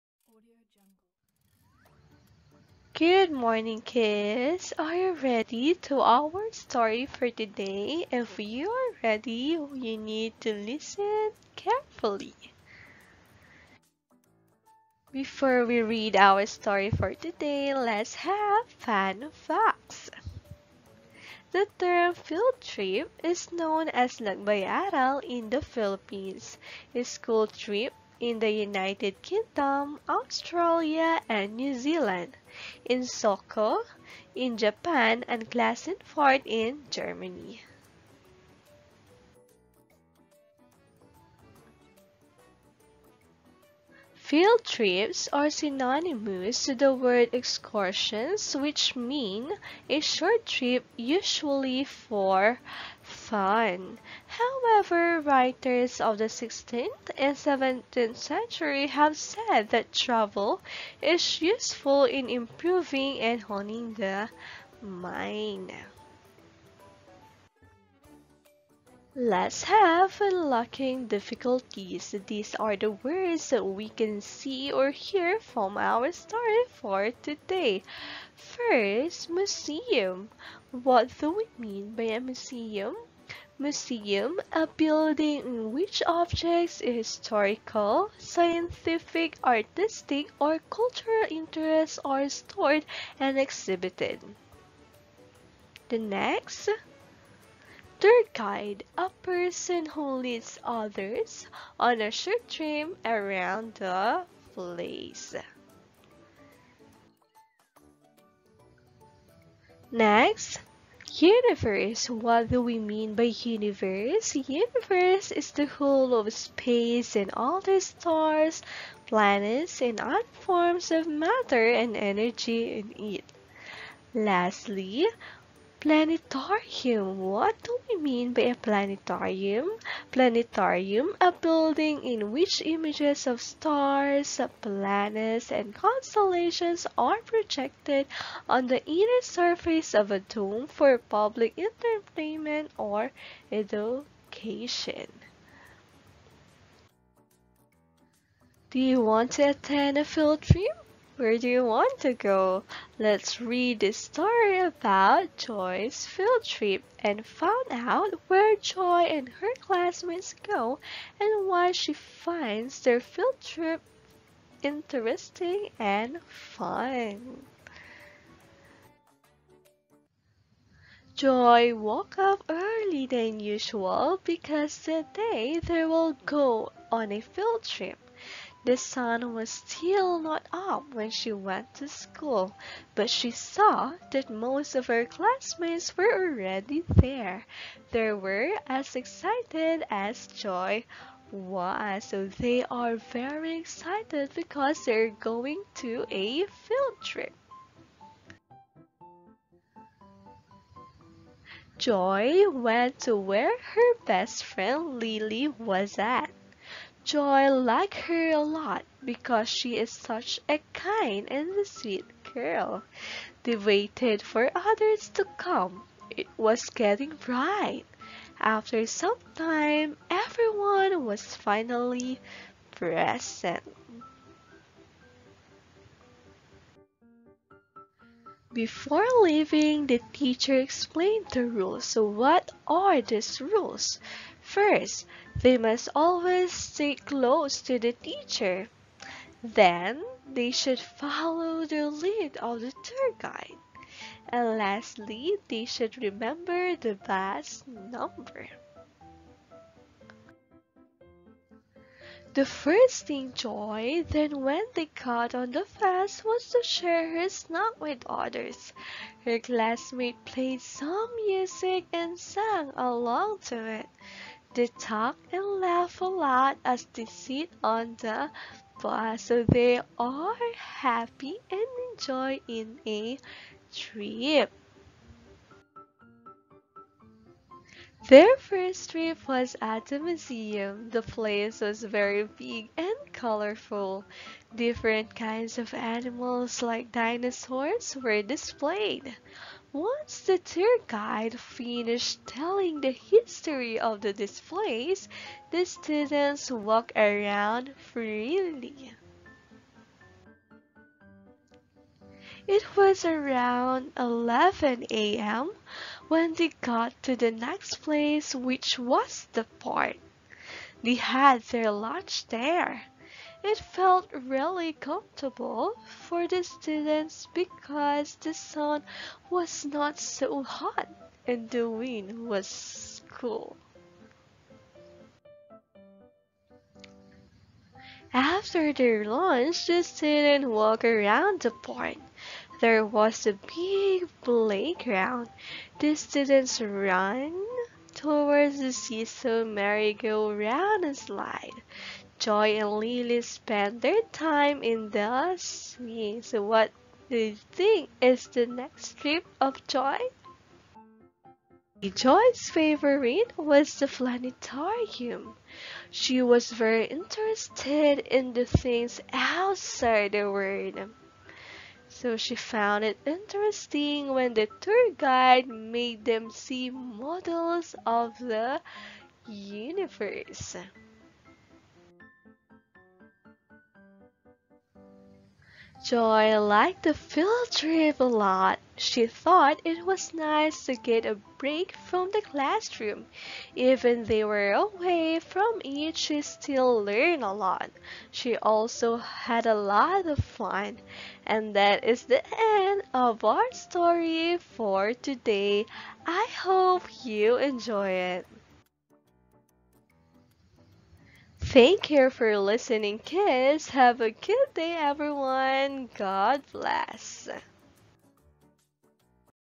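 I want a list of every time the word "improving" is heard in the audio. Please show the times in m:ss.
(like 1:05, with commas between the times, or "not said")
1:02.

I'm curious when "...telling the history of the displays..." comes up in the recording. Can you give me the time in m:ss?
4:52.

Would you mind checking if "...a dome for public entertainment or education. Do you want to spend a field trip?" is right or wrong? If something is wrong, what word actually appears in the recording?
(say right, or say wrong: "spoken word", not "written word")
wrong: "attend", not "spend".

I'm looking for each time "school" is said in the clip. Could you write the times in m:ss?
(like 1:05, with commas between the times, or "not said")
0:27, 3:01.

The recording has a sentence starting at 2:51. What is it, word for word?
Joy woke up early than usual because today they will go on a field trip.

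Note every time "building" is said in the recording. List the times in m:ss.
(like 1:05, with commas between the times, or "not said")
1:24, 2:11.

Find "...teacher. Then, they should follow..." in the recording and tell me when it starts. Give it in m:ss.
3:57.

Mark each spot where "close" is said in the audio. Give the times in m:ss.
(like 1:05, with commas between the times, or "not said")
3:56.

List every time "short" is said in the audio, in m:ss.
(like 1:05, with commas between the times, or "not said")
0:49, 1:42.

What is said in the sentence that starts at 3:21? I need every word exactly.
Joy went to where her best friend Lily was at.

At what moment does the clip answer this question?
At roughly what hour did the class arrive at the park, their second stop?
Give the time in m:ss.
5:03.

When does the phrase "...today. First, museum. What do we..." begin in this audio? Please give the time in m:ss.
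1:17.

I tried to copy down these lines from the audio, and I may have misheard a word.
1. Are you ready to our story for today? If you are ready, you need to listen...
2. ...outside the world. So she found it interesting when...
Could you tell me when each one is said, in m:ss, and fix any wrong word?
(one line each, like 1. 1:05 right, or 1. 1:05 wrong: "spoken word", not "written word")
1. 0:04 right
2. 5:59 right.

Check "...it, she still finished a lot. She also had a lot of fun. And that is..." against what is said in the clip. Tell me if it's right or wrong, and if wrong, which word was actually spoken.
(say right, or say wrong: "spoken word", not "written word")
wrong: "learned", not "finished".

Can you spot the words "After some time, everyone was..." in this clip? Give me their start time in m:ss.
3:38.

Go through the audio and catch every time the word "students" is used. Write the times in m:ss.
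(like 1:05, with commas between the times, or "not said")
4:55, 5:16, 5:29, 5:35.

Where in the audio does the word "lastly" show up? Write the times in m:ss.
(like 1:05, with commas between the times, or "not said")
2:04, 4:04.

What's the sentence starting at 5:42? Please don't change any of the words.
Joy and Lily spend their time in the sea.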